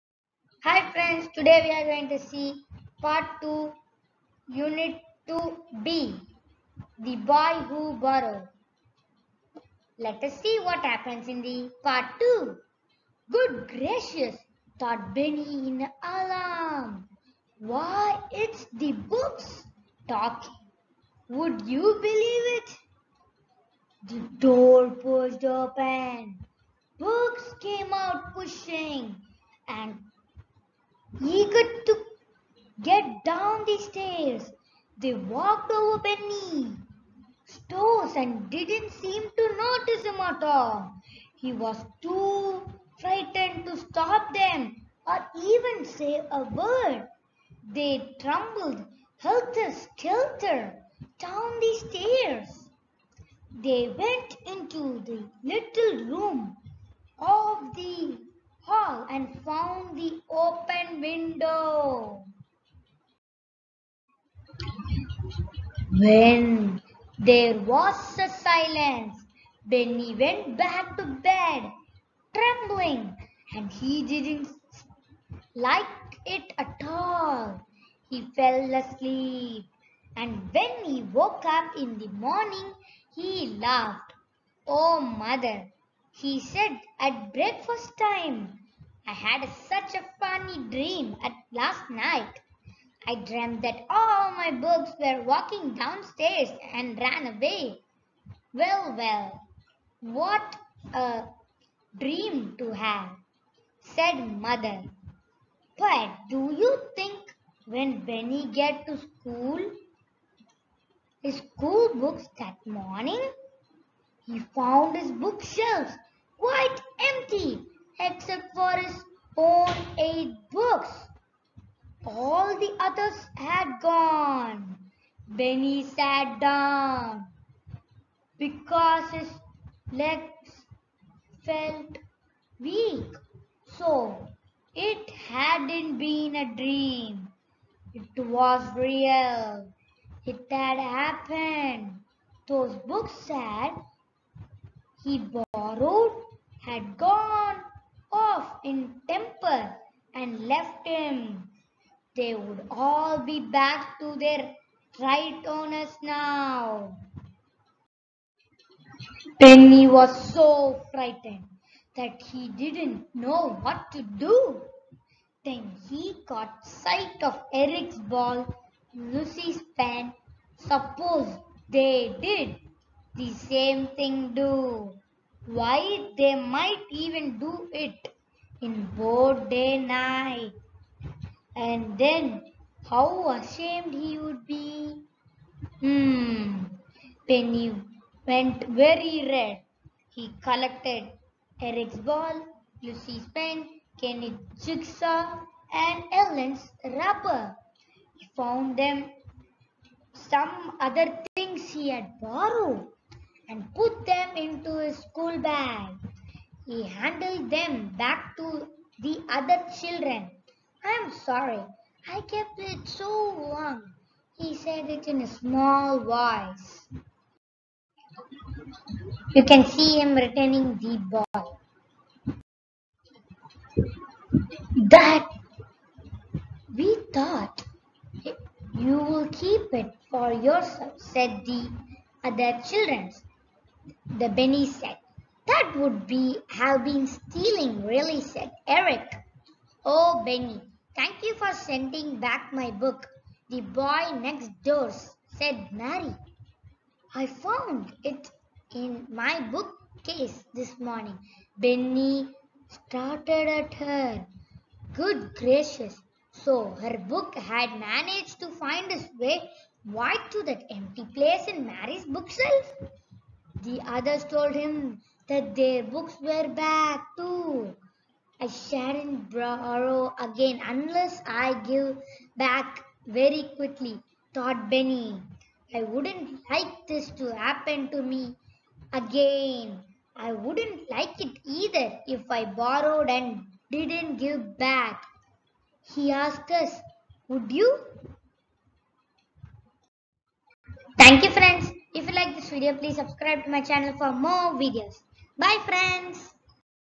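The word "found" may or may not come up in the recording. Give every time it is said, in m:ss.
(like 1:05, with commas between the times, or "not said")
0:59, 1:54, 3:18, 4:07.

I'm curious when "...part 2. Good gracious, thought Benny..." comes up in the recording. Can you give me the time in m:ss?
0:11.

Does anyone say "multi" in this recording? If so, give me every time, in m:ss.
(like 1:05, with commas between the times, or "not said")
not said.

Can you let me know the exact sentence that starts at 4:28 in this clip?
I shan't borrow again unless I give back very quickly, thought Benny.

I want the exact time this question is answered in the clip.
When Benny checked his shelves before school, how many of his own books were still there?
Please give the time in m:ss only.
1:59.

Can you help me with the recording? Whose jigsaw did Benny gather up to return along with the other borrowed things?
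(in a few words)
Kenny.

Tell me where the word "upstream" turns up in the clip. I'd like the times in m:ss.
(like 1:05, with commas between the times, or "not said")
not said.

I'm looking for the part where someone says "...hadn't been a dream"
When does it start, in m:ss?
2:15.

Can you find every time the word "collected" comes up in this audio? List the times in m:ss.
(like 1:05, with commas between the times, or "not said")
3:10.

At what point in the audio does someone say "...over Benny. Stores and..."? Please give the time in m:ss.
0:35.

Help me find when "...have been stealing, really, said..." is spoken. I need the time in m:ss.
3:56.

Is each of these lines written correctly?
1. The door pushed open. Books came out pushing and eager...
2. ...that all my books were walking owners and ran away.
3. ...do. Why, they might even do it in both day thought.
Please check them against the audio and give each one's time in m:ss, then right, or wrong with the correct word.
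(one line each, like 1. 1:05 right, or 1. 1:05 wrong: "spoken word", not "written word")
1. 0:24 right
2. 1:33 wrong: "downstairs", not "owners"
3. 2:54 wrong: "night", not "thought".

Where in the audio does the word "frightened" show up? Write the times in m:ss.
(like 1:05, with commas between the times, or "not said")
0:42, 2:40.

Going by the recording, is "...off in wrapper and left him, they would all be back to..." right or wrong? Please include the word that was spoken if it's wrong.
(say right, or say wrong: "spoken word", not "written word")
wrong: "temper", not "wrapper".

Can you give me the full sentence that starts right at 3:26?
He handed them back to the other children.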